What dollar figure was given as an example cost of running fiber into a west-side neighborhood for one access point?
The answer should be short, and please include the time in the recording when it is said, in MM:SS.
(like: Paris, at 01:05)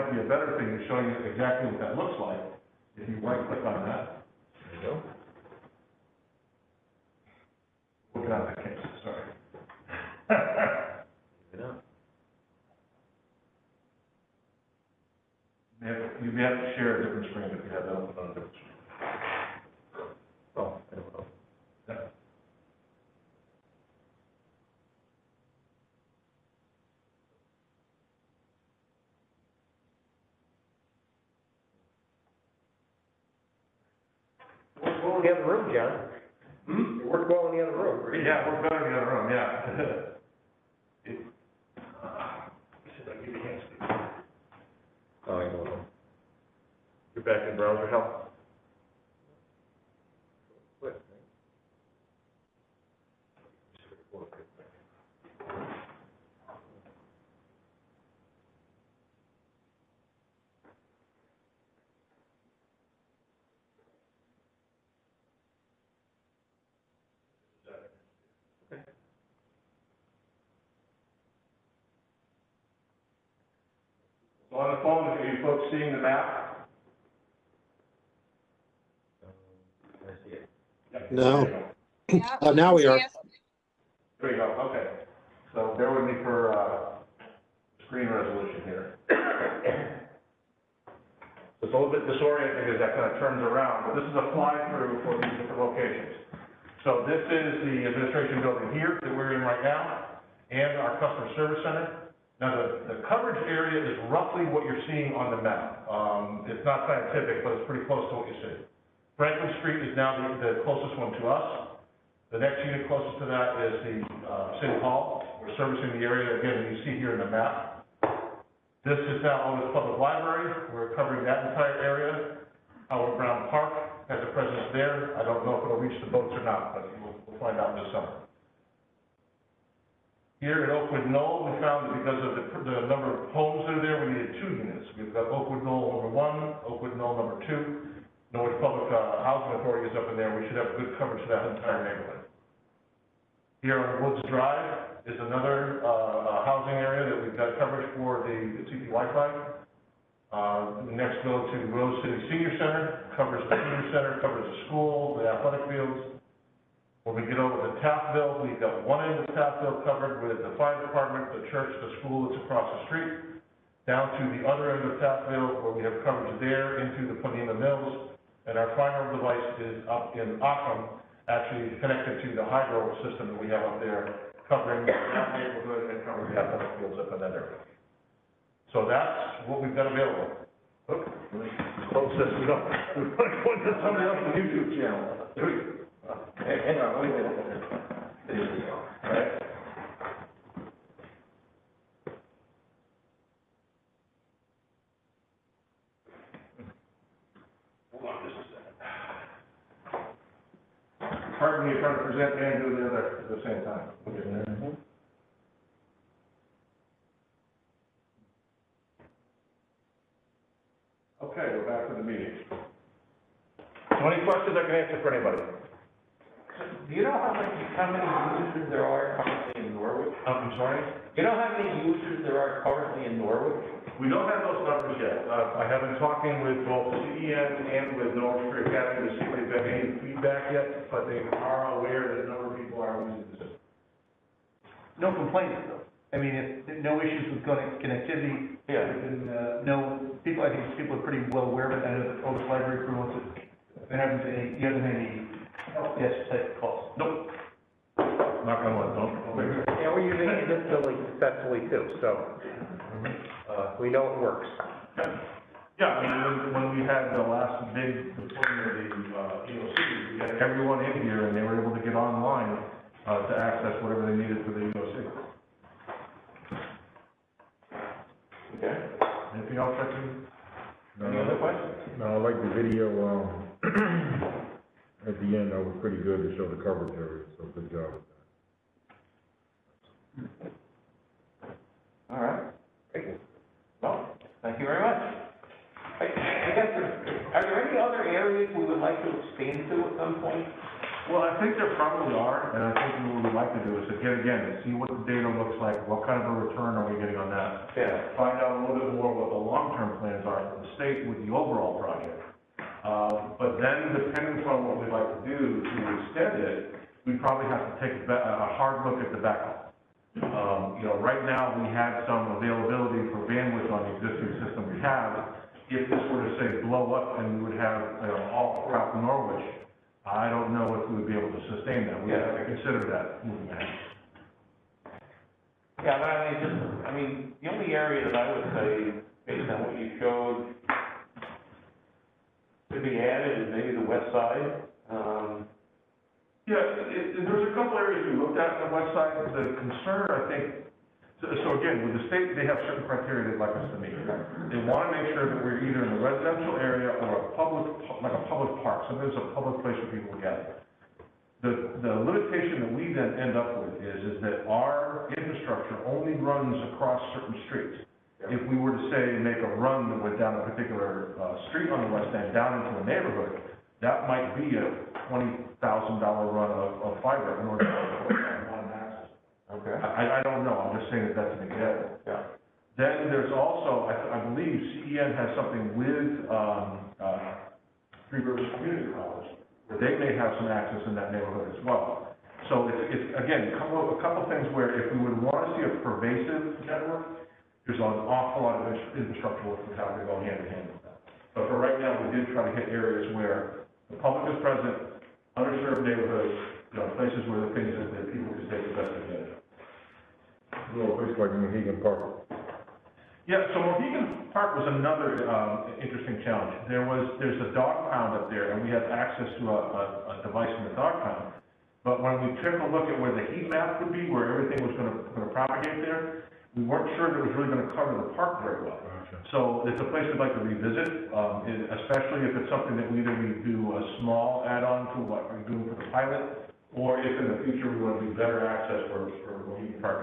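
$20,000, at 06:05.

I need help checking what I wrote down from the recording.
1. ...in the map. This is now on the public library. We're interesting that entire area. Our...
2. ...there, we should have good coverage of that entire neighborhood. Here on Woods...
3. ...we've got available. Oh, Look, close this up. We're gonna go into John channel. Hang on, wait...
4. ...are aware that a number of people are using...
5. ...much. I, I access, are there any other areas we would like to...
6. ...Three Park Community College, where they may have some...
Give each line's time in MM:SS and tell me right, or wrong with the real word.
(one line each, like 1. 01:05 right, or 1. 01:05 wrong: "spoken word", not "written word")
1. 01:57 wrong: "covering", not "interesting"
2. 02:20 right
3. 02:59 wrong: "YouTube", not "John"
4. 03:51 right
5. 04:44 wrong: "guess", not "access"
6. 06:18 wrong: "Rivers", not "Park".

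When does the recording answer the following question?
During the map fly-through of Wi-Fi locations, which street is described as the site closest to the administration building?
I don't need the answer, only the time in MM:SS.
01:49.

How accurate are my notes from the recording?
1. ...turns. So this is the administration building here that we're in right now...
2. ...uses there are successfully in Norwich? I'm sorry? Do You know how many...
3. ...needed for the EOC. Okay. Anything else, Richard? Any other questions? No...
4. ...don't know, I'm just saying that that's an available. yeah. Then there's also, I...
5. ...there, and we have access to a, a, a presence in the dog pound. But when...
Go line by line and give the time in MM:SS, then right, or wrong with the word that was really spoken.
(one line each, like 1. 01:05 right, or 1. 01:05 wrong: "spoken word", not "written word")
1. 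01:35 wrong: "locations", not "turns"
2. 03:38 wrong: "currently", not "successfully"
3. 04:24 right
4. 06:10 wrong: "example", not "available"
5. 06:48 wrong: "device", not "presence".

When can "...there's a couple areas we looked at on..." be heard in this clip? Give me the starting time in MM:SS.
05:37.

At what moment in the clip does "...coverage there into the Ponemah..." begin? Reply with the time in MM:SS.
02:46.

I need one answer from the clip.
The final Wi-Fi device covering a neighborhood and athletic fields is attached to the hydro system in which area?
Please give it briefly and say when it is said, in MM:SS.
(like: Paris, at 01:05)
Occum, at 02:50.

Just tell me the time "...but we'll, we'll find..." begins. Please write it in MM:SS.
02:06.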